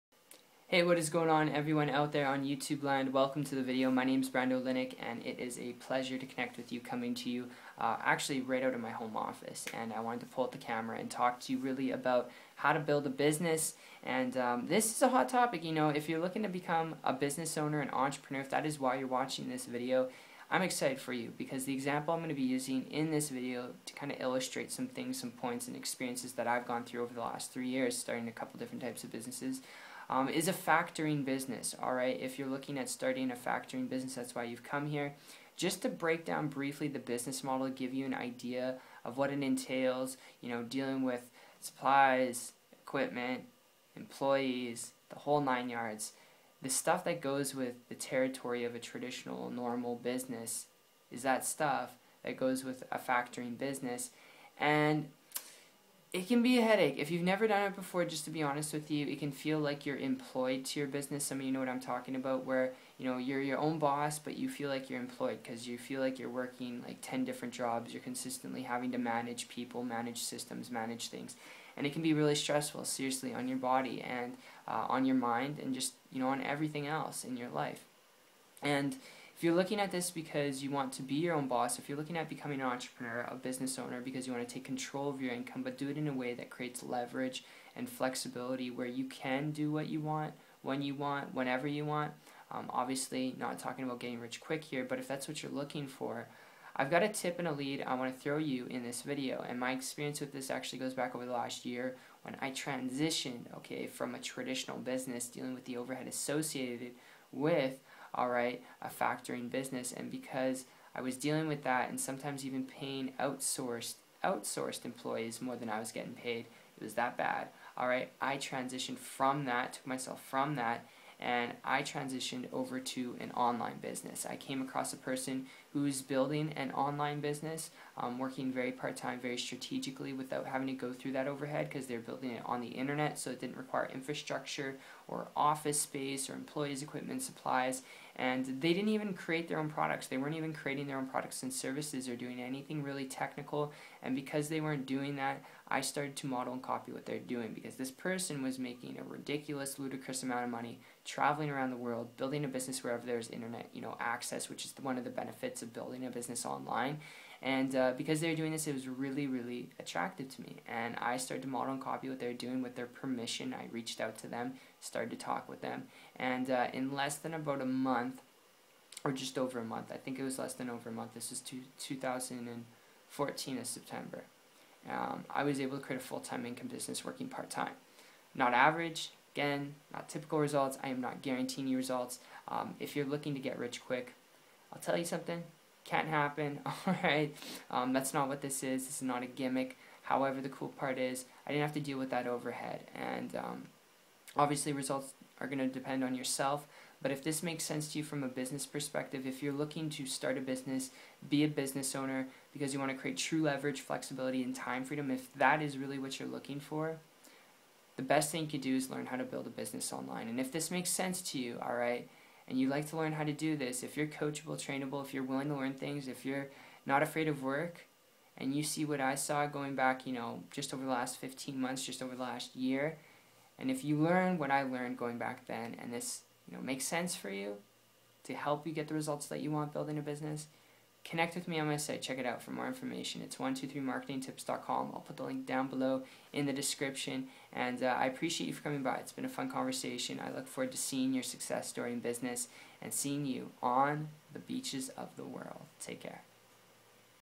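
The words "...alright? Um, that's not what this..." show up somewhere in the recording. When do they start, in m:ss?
3:06.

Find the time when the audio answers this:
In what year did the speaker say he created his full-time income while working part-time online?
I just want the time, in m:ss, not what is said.
2:51.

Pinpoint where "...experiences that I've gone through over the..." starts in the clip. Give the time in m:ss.
0:25.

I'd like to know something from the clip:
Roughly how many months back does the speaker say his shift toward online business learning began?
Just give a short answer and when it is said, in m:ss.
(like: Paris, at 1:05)
15 months, at 3:41.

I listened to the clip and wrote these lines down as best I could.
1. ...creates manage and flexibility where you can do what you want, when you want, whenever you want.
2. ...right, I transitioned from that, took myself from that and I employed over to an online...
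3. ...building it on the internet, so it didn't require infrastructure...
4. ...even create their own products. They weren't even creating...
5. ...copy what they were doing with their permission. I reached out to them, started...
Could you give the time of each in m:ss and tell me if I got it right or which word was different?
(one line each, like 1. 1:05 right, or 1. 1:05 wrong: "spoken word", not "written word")
1. 1:26 wrong: "leverage", not "manage"
2. 1:57 wrong: "transitioned", not "employed"
3. 2:11 right
4. 2:18 right
5. 2:41 right.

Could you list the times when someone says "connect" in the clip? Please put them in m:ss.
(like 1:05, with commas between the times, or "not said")
0:06, 3:51.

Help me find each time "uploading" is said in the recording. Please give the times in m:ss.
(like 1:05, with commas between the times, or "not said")
not said.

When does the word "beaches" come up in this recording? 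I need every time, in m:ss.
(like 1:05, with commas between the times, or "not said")
4:04.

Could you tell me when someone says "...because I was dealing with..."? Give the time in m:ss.
1:50.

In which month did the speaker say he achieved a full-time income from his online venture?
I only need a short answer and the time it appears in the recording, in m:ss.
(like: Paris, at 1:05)
September, at 2:53.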